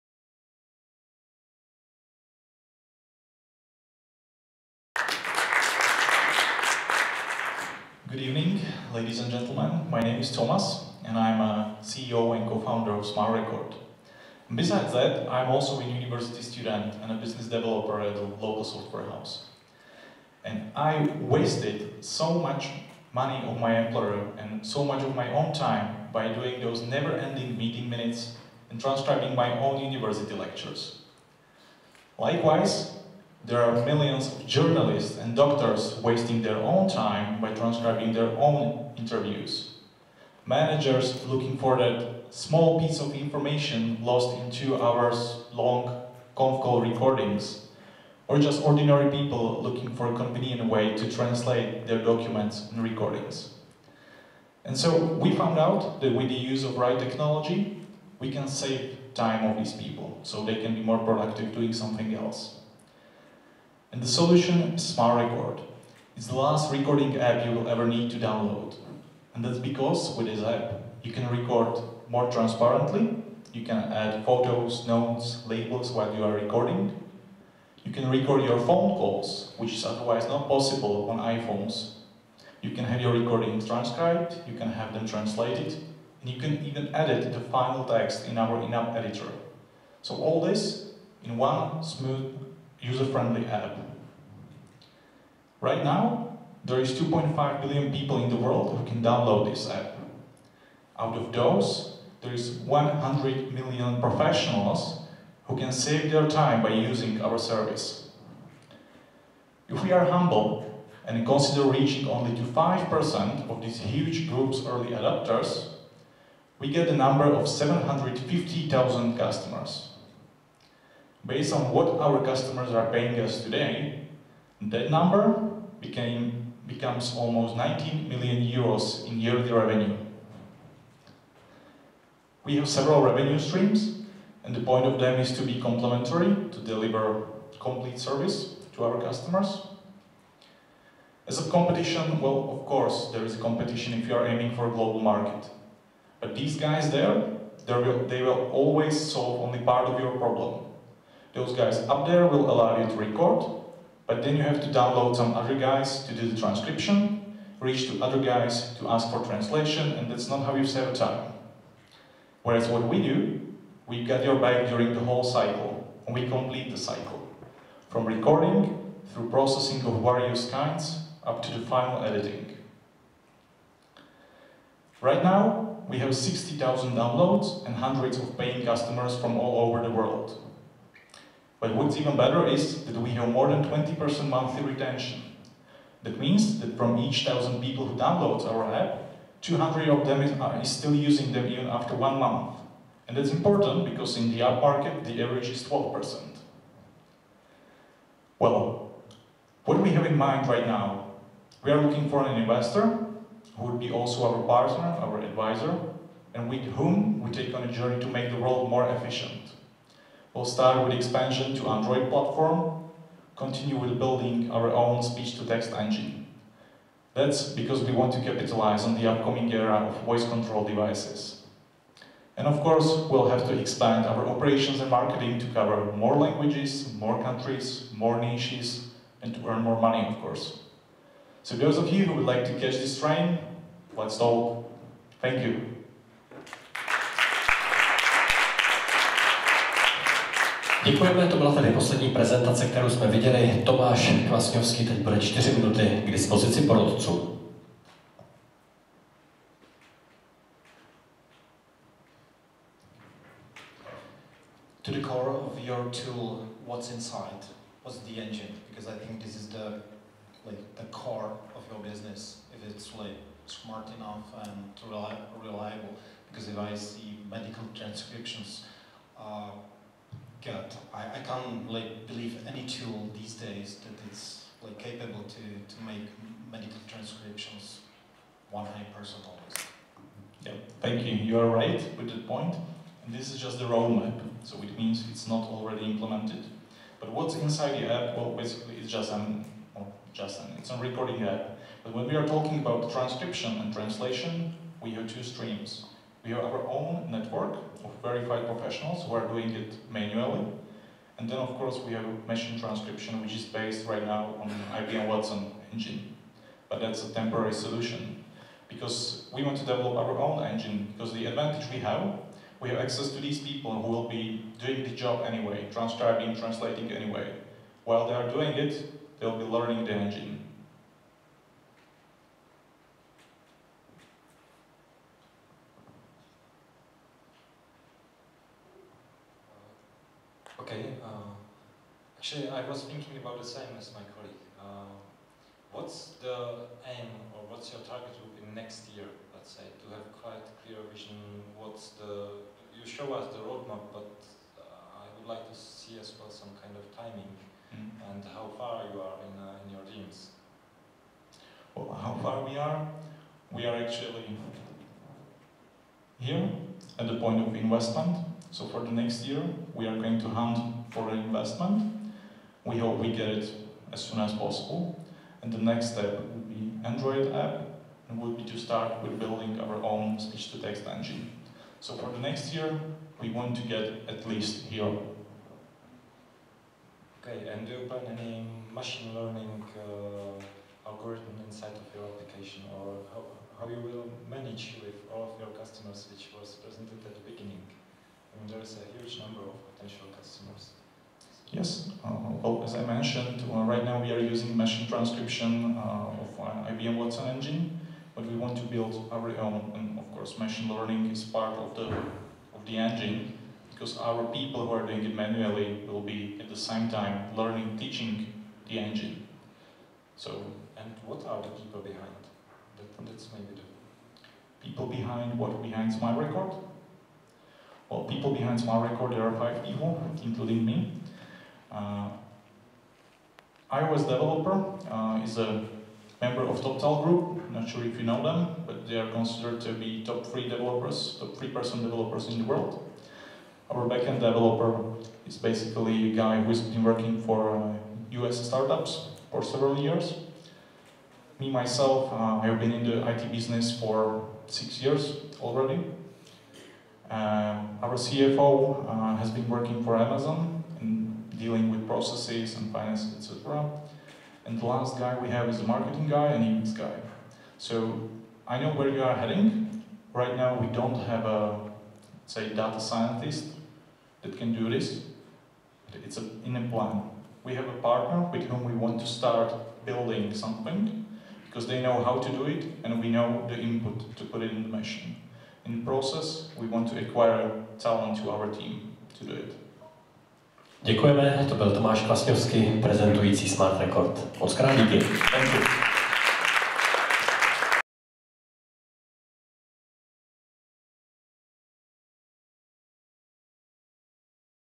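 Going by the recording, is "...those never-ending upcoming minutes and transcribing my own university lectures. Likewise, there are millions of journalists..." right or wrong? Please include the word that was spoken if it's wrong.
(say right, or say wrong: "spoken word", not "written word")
wrong: "meeting", not "upcoming".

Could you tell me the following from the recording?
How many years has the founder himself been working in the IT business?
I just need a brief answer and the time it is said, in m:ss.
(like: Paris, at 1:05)
6 years, at 7:24.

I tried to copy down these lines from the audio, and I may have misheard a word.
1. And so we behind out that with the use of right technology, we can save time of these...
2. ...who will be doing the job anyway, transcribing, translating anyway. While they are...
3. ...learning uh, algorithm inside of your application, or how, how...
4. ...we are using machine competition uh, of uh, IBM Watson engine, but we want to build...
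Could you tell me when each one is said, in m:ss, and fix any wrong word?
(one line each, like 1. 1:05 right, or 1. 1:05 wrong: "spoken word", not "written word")
1. 0:54 wrong: "found", not "behind"
2. 5:13 right
3. 6:19 right
4. 6:34 wrong: "transcription", not "competition".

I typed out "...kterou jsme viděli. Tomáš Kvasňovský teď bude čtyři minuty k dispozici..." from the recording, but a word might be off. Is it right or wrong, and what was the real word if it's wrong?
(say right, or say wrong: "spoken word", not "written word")
right.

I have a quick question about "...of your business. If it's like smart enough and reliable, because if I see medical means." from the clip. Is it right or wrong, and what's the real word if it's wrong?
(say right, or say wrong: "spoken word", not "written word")
wrong: "transcriptions", not "means".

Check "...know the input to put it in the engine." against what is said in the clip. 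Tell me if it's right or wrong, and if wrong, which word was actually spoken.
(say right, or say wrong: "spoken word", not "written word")
wrong: "machine", not "engine".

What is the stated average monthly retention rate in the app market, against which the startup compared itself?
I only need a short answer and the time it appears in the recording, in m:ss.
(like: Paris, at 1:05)
12%, at 3:15.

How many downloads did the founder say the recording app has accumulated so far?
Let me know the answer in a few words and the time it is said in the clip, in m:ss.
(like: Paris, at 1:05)
60,000, at 2:56.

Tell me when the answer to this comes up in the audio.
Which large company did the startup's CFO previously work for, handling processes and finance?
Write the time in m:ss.
7:29.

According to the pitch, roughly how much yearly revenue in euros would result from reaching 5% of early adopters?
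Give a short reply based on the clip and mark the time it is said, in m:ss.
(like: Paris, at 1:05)
19 million euros, at 2:07.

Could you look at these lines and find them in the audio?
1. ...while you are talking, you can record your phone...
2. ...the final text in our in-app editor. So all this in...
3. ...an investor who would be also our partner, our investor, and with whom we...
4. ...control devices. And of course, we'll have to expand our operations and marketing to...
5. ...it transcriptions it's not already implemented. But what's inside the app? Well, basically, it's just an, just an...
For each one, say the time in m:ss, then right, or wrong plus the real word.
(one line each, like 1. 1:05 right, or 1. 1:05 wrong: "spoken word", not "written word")
1. 1:15 wrong: "recording", not "talking"
2. 1:27 right
3. 3:22 wrong: "advisor", not "investor"
4. 3:40 right
5. 4:44 wrong: "means", not "transcriptions".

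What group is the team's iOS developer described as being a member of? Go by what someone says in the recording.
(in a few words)
TopTal.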